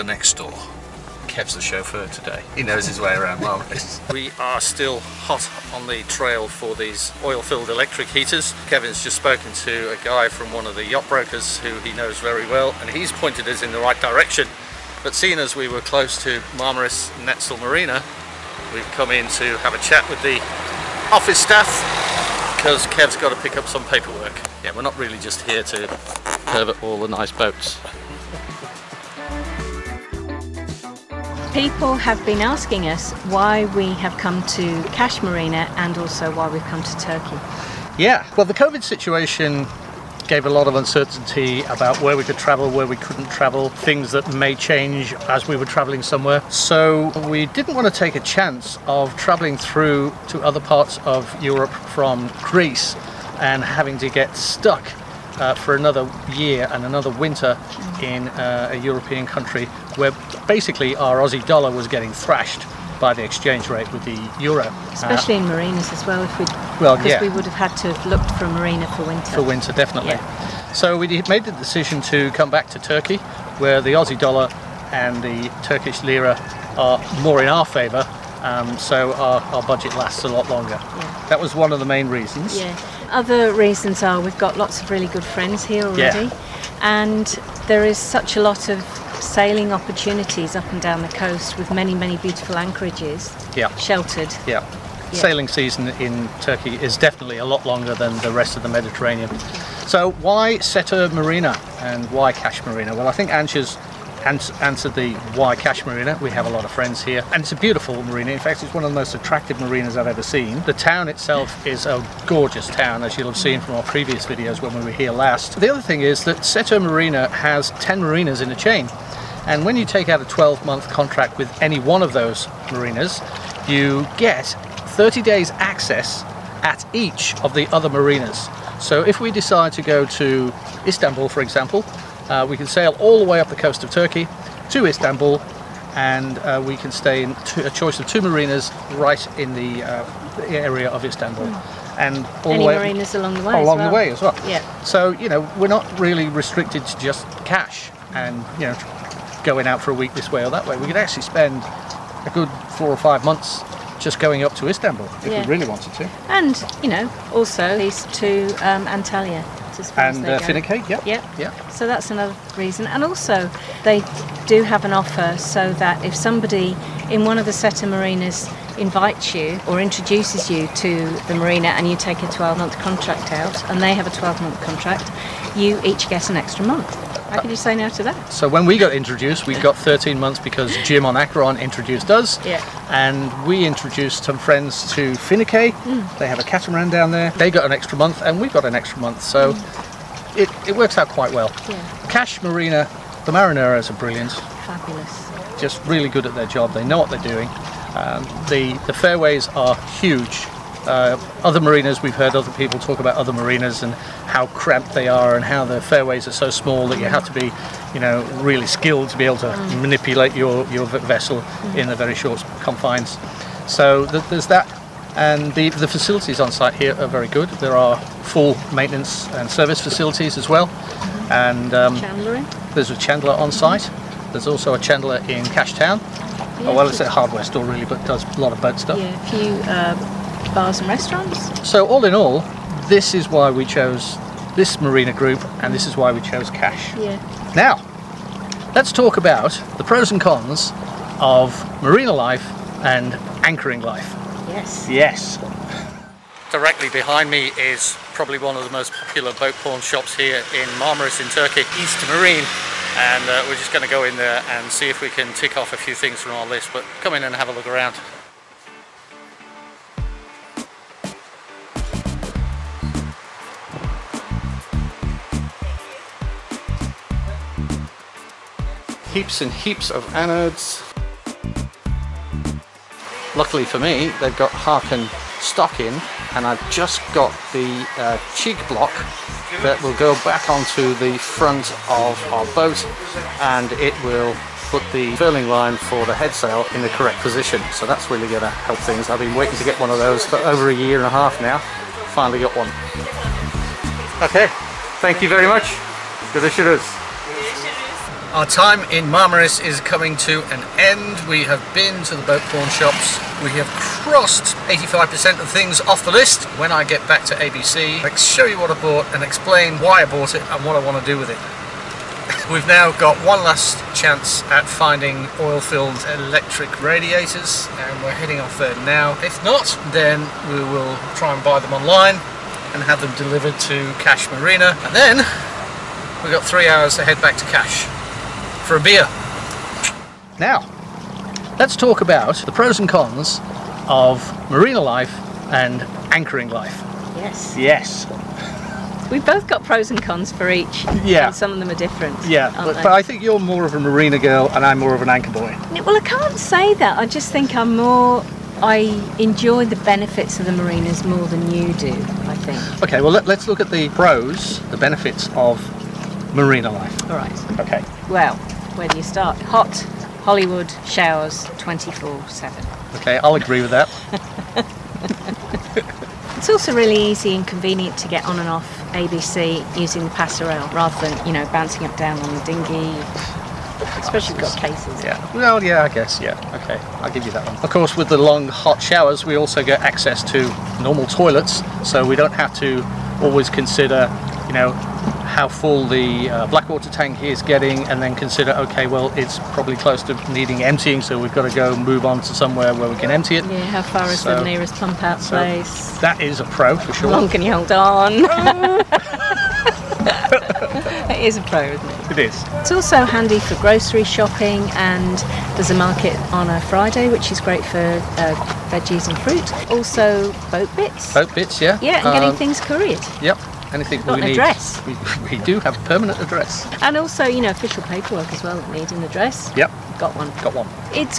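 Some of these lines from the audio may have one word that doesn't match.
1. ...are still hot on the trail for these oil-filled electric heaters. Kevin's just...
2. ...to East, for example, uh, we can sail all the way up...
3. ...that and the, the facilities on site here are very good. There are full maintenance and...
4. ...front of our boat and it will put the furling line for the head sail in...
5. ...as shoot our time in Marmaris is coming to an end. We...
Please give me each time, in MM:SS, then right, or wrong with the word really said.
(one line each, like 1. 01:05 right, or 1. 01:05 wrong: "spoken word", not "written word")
1. 00:04 right
2. 02:10 wrong: "Istanbul", not "East"
3. 03:34 right
4. 04:41 right
5. 04:56 right.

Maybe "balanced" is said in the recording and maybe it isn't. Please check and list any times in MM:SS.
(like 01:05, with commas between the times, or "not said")
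not said.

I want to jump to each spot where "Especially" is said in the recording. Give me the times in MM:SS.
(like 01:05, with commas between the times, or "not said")
01:04, 06:13.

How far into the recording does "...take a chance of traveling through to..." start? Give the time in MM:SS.
00:47.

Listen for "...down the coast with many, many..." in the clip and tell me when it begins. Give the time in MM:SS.
01:30.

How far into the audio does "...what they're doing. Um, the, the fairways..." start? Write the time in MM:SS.
03:16.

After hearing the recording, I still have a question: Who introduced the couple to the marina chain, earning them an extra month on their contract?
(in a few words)
Jim.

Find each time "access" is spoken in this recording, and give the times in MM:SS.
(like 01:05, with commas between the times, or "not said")
02:05, 06:19.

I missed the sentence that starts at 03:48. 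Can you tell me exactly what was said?
Yeah, a few uh, bars and restaurants.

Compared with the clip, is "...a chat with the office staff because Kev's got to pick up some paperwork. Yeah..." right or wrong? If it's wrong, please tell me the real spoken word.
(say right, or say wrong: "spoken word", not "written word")
right.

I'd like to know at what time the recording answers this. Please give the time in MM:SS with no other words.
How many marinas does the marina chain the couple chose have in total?
01:57.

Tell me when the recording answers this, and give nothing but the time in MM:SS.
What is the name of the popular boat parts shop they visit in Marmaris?
04:11.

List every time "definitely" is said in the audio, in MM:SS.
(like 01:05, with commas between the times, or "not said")
01:09, 01:36.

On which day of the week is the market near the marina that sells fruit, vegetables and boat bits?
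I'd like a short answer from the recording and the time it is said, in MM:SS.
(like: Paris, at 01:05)
Friday, at 06:46.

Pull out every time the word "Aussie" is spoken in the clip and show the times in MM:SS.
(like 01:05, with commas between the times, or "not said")
01:01, 01:13.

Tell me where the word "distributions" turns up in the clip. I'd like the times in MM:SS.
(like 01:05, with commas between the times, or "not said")
not said.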